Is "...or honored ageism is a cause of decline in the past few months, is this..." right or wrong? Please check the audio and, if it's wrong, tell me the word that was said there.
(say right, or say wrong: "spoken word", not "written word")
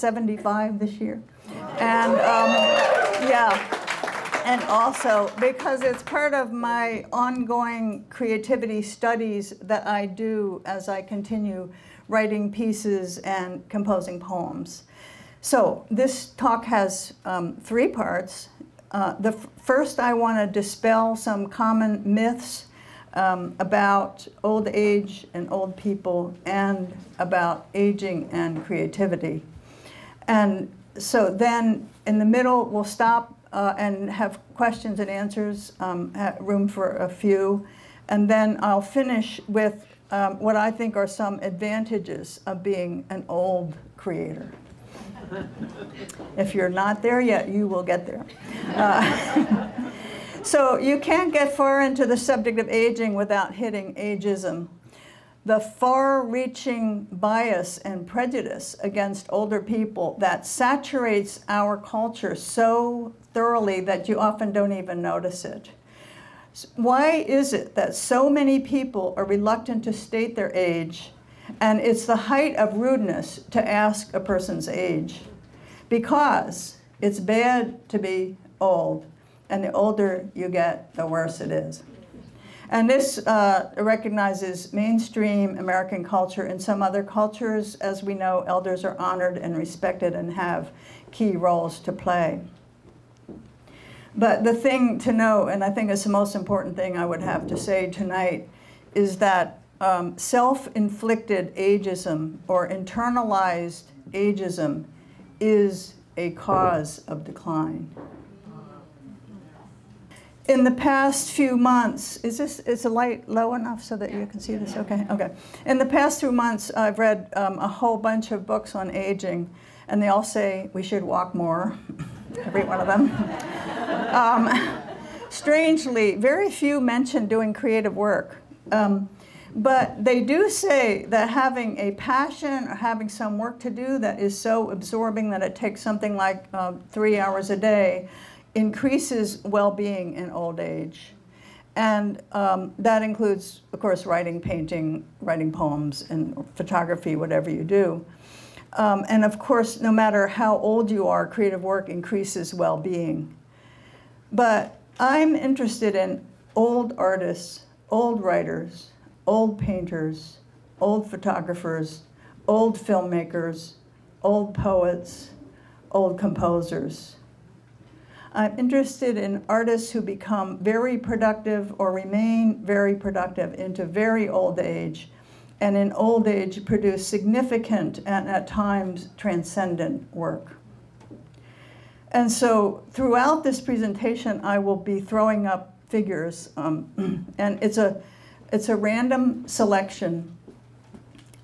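wrong: "internalized", not "honored".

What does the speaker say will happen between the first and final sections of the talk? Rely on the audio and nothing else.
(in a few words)
Questions and answers.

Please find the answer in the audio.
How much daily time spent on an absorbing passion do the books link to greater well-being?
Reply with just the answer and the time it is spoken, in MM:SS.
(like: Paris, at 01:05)
3 hours a day, at 02:16.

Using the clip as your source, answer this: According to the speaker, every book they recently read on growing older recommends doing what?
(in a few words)
Walk more.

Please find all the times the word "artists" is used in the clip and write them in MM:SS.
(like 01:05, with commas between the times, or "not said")
02:36, 02:49.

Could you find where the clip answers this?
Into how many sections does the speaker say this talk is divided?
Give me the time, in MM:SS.
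00:17.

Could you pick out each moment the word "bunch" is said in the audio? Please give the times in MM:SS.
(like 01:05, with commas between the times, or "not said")
01:57.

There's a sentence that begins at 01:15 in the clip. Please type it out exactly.
Because it's bad to be old and the older you get, the worse it is.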